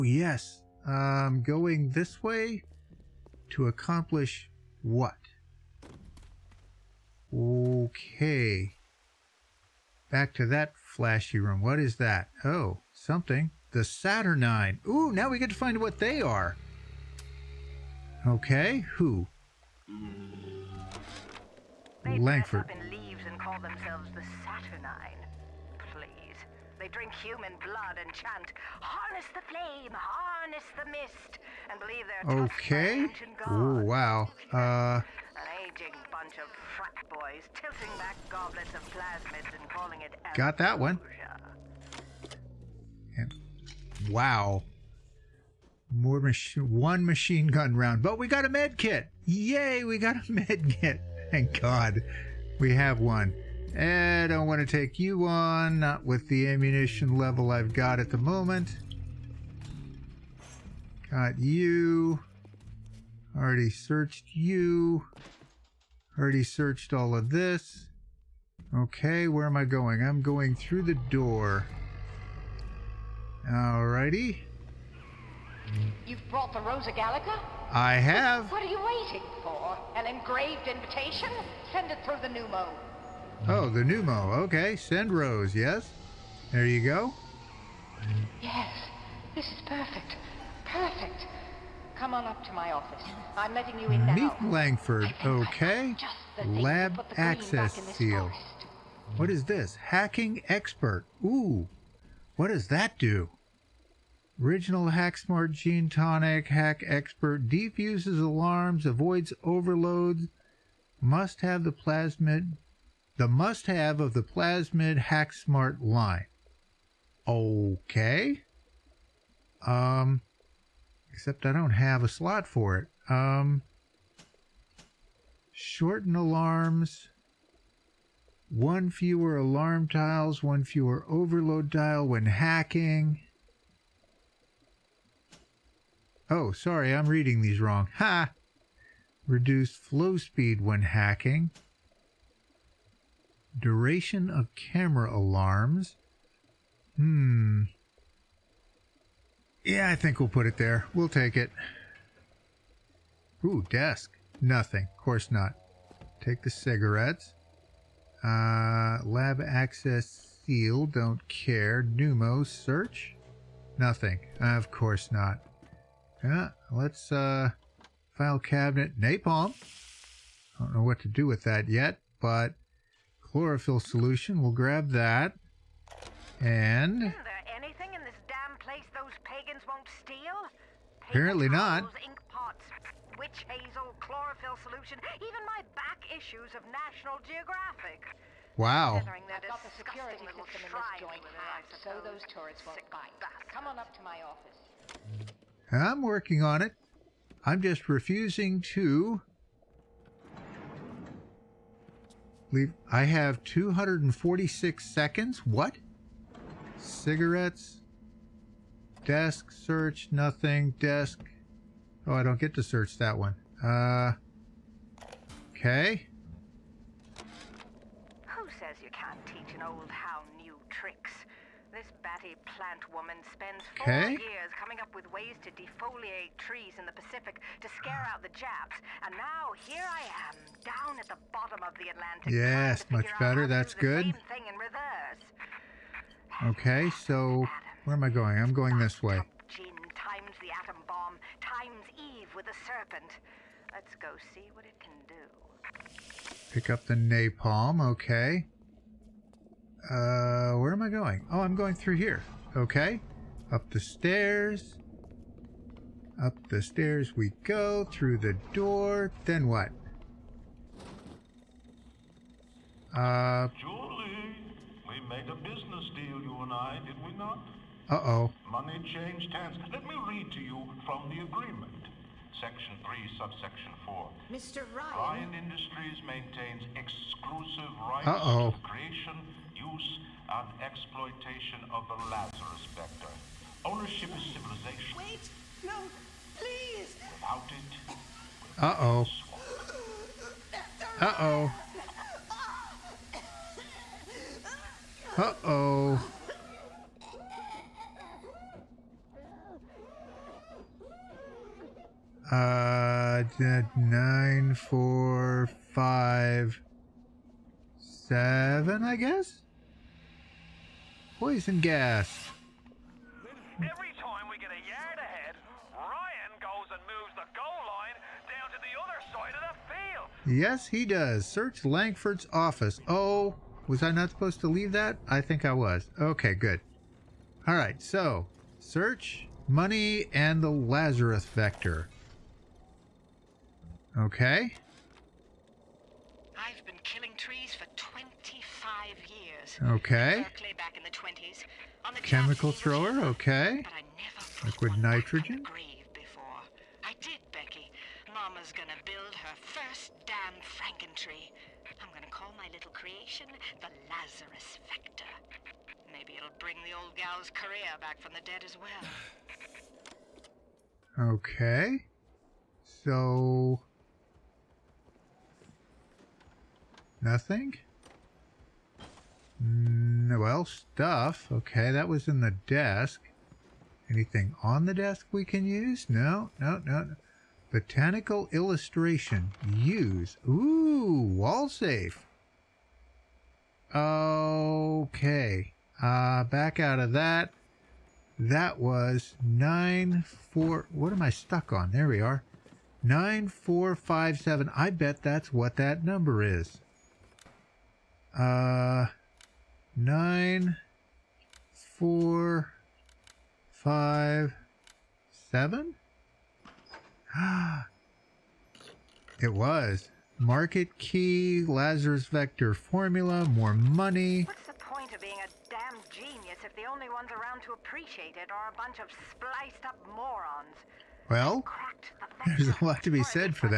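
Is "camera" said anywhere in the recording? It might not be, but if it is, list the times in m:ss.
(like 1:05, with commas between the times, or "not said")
2:24.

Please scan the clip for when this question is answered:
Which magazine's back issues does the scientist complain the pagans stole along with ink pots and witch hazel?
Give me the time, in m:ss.
3:06.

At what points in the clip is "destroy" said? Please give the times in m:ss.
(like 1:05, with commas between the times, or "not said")
not said.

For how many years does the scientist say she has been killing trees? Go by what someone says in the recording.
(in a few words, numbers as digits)
25.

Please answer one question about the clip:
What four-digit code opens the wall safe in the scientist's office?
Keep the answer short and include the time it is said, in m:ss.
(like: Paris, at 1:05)
9457, at 6:32.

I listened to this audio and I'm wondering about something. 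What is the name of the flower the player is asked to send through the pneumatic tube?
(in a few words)
Rosa Gallica.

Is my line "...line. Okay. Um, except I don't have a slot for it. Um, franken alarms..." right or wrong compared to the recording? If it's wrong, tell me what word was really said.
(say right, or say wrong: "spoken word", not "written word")
wrong: "shorten", not "franken".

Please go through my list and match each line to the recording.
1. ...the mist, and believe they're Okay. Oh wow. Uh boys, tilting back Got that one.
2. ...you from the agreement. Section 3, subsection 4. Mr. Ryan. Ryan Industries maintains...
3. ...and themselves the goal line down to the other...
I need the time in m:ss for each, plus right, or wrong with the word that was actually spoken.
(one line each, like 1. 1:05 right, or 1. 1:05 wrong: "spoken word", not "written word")
1. 0:30 right
2. 4:30 right
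3. 5:16 wrong: "moves", not "themselves".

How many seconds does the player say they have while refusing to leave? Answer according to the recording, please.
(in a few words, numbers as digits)
246.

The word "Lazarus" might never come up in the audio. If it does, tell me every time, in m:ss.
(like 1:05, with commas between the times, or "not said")
4:42, 5:30, 5:53, 6:51.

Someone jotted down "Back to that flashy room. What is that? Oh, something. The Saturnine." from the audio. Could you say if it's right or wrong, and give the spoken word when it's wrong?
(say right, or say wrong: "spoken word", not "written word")
right.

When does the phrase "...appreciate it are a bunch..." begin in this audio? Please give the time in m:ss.
6:57.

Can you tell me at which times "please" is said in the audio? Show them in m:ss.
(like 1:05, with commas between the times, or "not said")
0:25, 4:46.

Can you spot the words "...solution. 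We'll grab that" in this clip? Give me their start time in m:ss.
2:53.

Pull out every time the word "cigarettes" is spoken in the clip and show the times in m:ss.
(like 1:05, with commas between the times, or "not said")
2:36, 3:26.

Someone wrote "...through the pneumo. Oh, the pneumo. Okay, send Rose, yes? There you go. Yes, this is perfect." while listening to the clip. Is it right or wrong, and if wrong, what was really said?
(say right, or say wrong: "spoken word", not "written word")
right.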